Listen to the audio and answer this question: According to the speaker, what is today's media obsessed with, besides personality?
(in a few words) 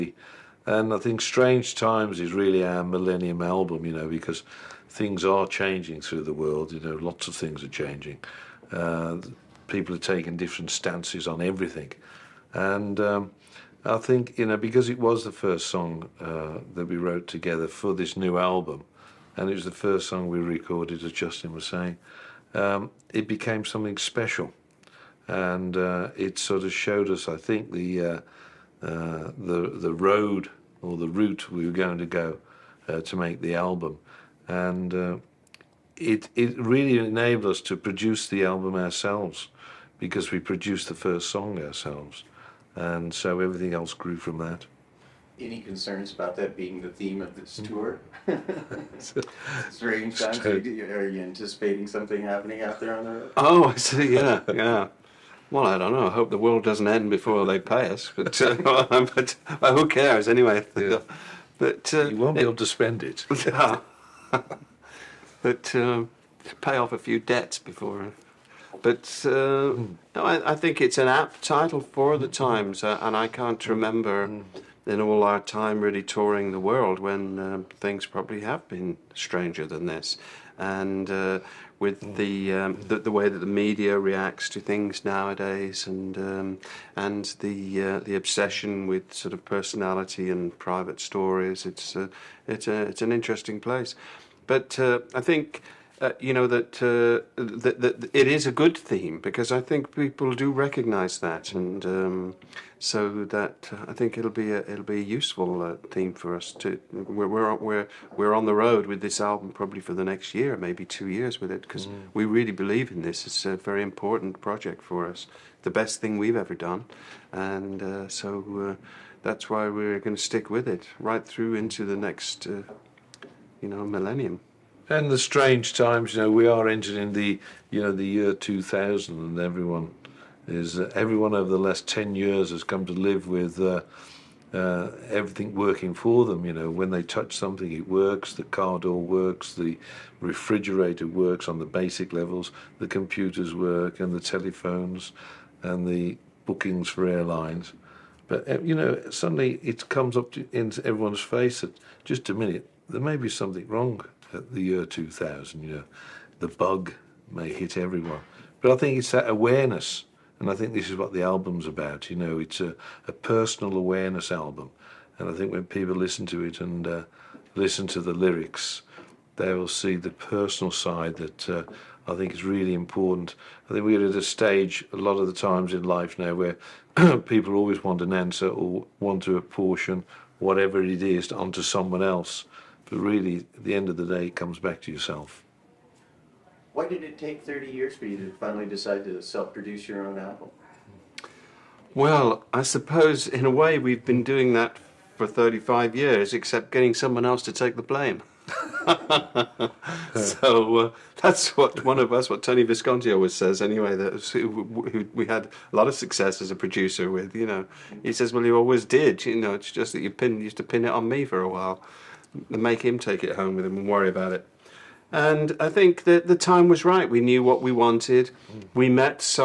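private stories.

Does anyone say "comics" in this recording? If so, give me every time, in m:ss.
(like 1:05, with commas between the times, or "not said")
not said.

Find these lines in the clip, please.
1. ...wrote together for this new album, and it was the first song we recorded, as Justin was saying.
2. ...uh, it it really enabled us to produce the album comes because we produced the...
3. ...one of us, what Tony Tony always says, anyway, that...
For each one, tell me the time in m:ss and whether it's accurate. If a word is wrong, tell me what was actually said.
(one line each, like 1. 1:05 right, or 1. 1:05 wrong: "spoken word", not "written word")
1. 0:16 right
2. 0:34 wrong: "ourselves", not "comes"
3. 3:21 wrong: "Visconti", not "Tony".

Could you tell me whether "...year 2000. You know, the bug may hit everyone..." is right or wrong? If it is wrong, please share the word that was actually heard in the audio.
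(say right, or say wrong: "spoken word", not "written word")
right.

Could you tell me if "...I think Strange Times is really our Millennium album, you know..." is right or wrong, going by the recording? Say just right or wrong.
right.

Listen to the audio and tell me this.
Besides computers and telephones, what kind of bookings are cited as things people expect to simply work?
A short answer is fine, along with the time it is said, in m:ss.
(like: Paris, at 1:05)
airlines, at 2:27.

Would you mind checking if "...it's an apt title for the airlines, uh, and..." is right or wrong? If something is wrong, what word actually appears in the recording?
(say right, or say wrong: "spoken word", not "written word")
wrong: "times", not "airlines".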